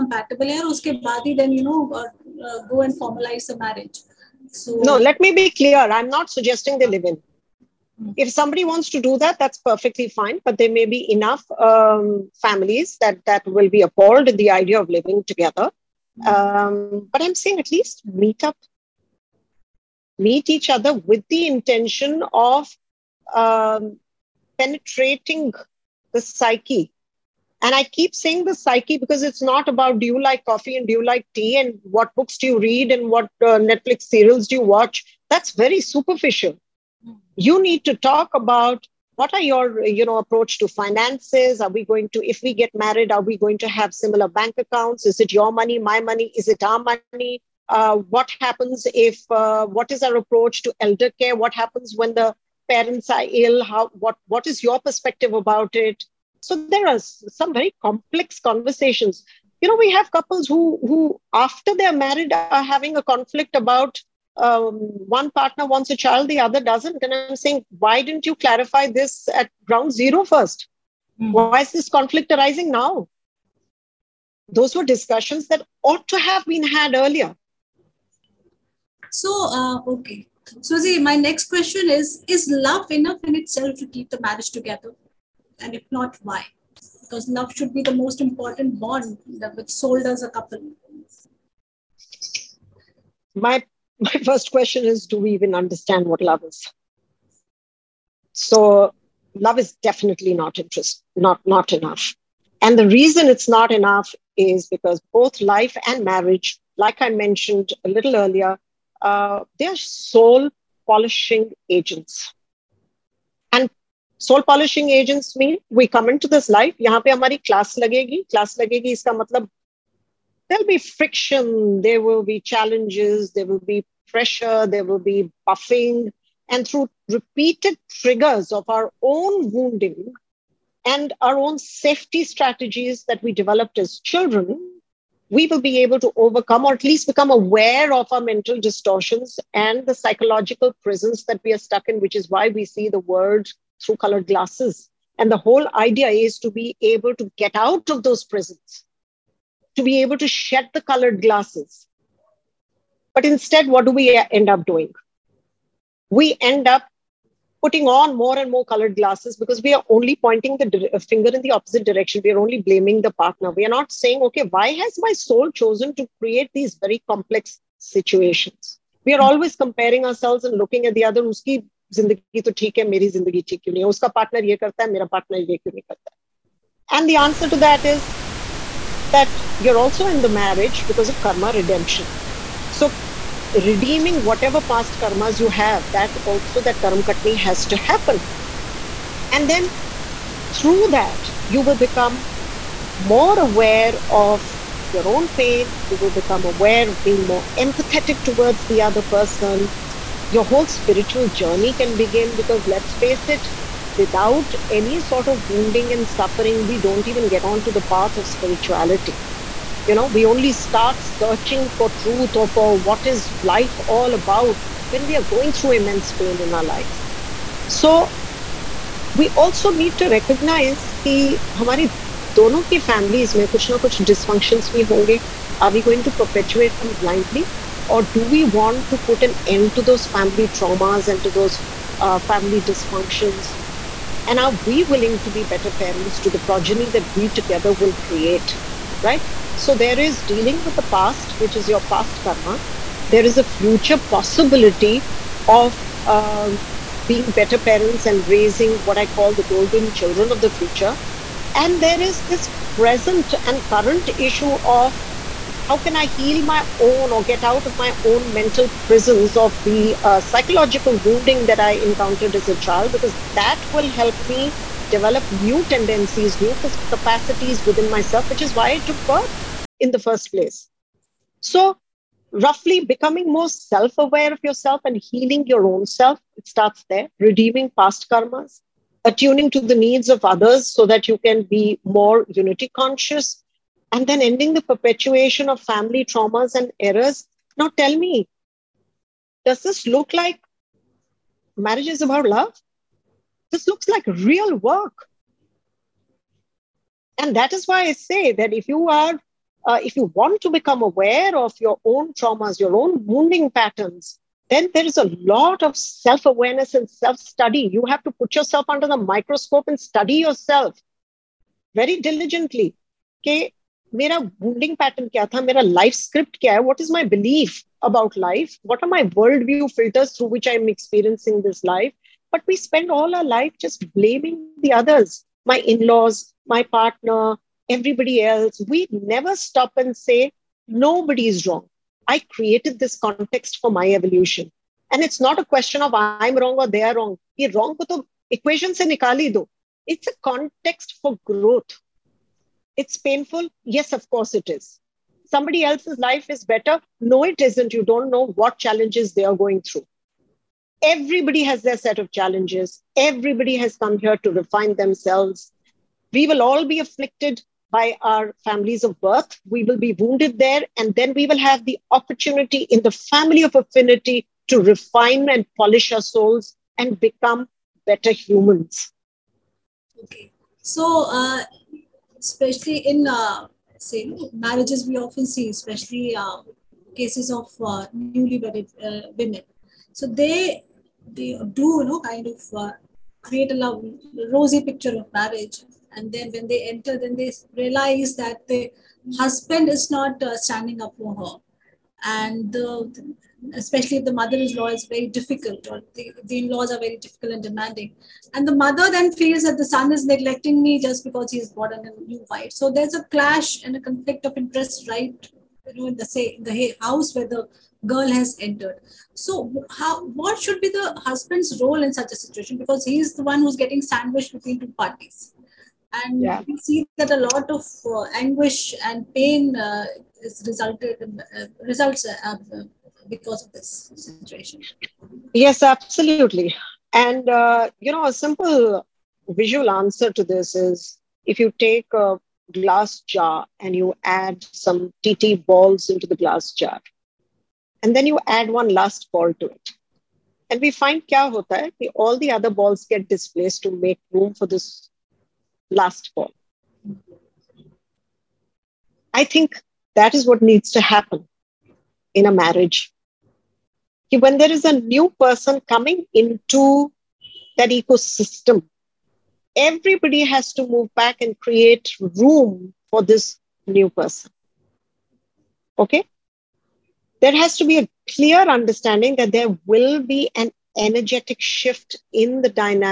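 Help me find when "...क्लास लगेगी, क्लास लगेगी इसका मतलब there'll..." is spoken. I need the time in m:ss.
1:57.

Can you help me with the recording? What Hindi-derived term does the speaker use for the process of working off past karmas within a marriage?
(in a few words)
karmakatni.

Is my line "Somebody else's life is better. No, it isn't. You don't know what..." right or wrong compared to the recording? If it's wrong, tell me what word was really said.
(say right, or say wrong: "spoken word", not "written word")
right.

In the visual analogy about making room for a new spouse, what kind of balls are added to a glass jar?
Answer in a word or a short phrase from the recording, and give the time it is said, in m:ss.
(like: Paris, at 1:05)
TT balls, at 7:15.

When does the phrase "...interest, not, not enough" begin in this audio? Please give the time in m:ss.
1:40.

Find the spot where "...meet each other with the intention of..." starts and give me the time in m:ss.
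0:20.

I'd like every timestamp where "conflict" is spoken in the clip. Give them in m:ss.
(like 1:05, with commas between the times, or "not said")
1:03, 1:11, 6:43.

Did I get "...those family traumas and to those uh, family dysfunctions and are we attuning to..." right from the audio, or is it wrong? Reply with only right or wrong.
wrong.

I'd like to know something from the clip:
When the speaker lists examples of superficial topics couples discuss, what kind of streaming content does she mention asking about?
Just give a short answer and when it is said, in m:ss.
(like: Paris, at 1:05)
Netflix serials, at 0:33.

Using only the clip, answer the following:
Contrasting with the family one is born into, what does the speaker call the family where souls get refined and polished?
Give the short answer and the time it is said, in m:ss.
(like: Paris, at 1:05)
family of affinity, at 6:02.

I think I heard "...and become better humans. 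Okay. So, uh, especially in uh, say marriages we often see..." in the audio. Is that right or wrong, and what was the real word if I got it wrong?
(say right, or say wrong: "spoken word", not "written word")
right.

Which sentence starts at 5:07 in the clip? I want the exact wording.
You have to put yourself under the microscope and study yourself very diligently.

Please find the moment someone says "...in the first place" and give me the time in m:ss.
4:29.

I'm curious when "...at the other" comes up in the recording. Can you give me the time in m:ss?
2:50.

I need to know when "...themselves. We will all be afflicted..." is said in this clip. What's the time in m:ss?
5:54.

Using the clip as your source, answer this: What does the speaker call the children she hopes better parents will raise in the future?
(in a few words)
golden children.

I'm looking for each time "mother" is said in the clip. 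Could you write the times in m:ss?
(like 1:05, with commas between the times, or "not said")
6:34, 6:38.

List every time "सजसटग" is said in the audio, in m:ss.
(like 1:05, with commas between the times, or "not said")
0:06.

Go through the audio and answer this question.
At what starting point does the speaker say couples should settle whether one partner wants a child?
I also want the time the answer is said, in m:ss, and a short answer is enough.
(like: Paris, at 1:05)
ground zero, at 1:09.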